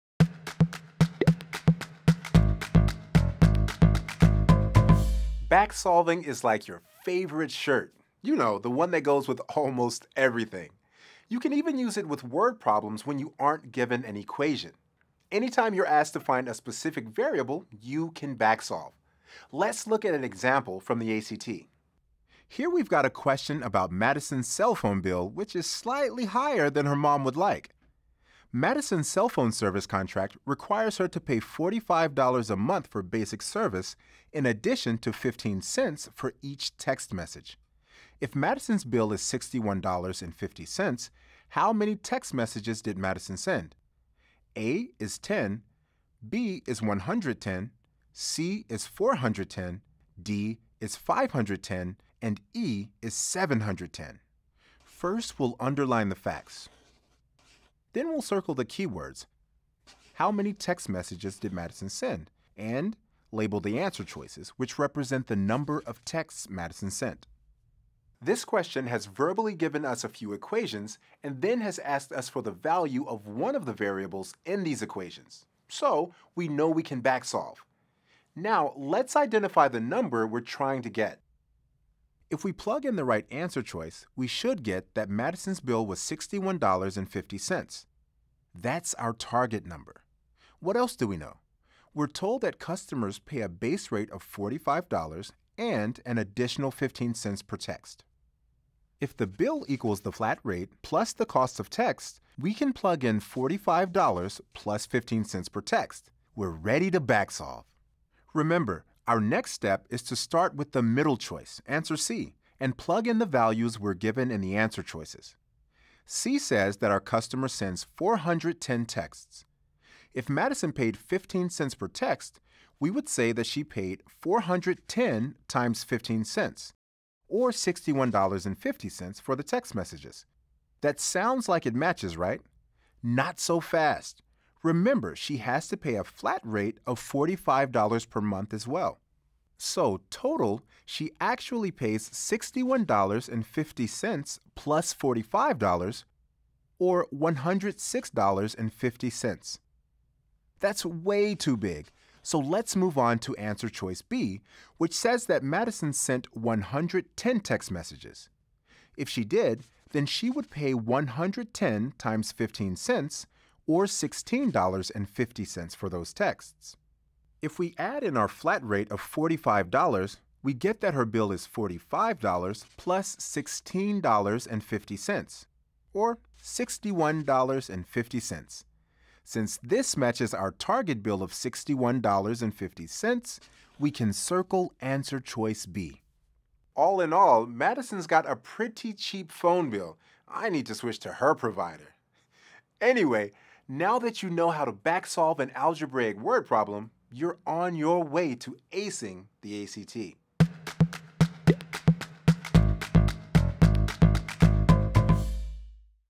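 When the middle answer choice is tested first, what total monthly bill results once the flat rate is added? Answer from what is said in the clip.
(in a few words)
$106.50.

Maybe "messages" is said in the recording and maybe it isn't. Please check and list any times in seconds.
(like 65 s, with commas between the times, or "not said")
37 s, 42 s, 60 s, 129 s, 157 s.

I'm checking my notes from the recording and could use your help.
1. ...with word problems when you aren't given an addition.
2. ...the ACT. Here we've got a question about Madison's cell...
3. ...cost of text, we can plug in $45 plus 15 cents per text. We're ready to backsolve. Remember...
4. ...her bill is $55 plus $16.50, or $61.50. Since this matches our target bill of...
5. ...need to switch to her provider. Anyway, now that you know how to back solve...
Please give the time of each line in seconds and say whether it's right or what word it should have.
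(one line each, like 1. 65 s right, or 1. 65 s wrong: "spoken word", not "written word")
1. 12 s wrong: "equation", not "addition"
2. 20 s right
3. 101 s right
4. 170 s wrong: "45", not "55"
5. 190 s right.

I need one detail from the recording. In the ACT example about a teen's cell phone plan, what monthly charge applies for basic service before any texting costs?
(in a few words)
$45.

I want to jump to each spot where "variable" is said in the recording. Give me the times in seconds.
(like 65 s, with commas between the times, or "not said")
17 s, 73 s.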